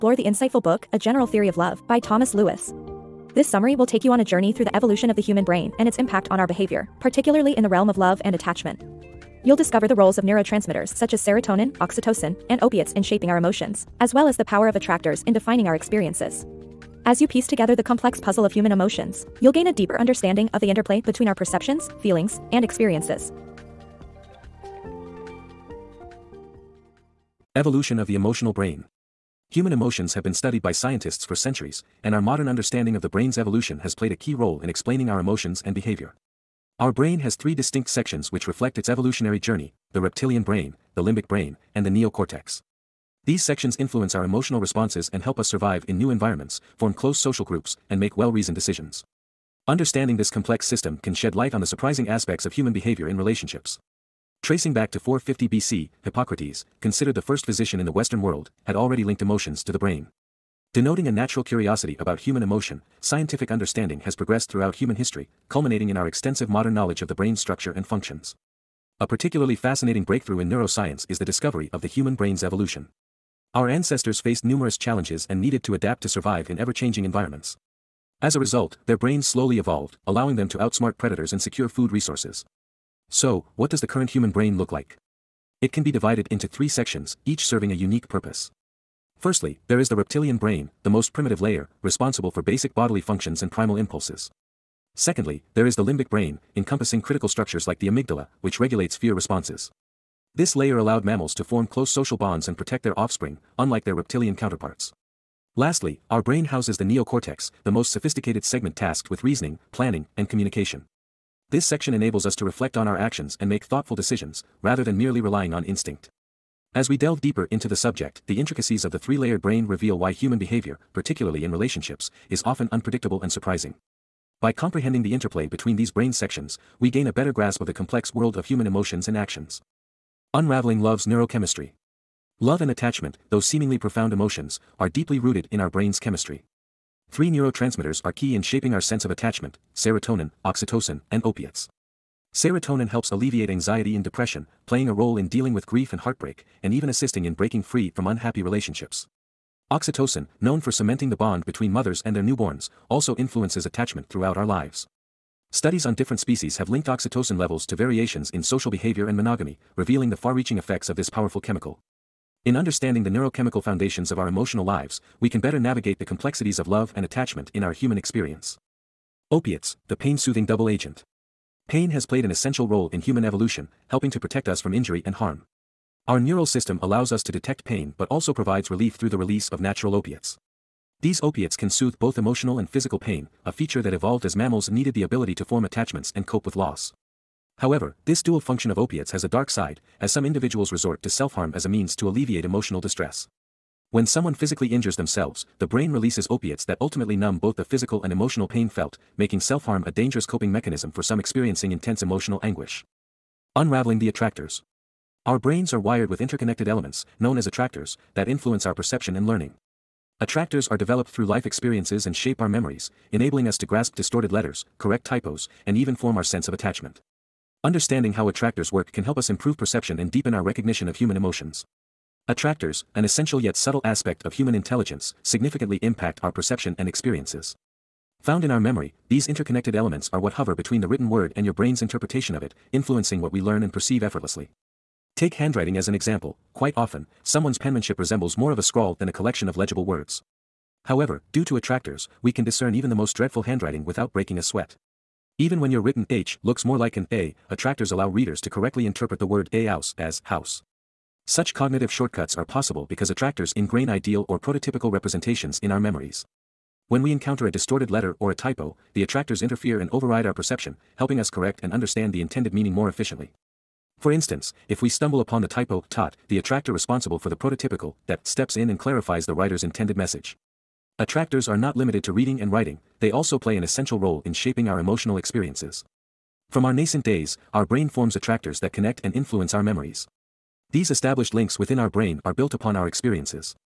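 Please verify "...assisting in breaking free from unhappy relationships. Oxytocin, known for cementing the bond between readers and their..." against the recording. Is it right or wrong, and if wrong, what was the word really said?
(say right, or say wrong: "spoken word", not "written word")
wrong: "mothers", not "readers".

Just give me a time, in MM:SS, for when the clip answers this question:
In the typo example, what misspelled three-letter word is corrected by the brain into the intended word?
04:25.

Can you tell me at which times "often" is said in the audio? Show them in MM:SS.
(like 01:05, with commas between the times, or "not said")
02:02, 03:56.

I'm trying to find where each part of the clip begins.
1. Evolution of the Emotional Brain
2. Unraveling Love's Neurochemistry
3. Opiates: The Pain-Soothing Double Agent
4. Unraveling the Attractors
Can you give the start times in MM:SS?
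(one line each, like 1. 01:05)
1. 00:27
2. 02:10
3. 02:49
4. 03:23.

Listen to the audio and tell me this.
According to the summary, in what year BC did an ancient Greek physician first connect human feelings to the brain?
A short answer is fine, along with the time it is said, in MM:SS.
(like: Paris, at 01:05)
450 BC, at 00:54.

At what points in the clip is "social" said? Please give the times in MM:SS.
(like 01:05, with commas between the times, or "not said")
00:47, 01:41, 02:38.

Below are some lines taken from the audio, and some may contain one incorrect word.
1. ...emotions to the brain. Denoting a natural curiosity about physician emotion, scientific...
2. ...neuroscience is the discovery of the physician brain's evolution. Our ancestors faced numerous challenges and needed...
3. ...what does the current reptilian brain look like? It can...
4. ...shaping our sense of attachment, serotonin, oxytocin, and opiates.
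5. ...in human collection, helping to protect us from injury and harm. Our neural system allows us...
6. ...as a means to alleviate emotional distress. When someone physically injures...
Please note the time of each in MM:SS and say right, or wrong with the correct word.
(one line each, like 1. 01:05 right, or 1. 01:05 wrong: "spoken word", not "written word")
1. 00:59 wrong: "human", not "physician"
2. 01:10 wrong: "human", not "physician"
3. 01:23 wrong: "human", not "reptilian"
4. 02:18 right
5. 02:52 wrong: "evolution", not "collection"
6. 03:11 right.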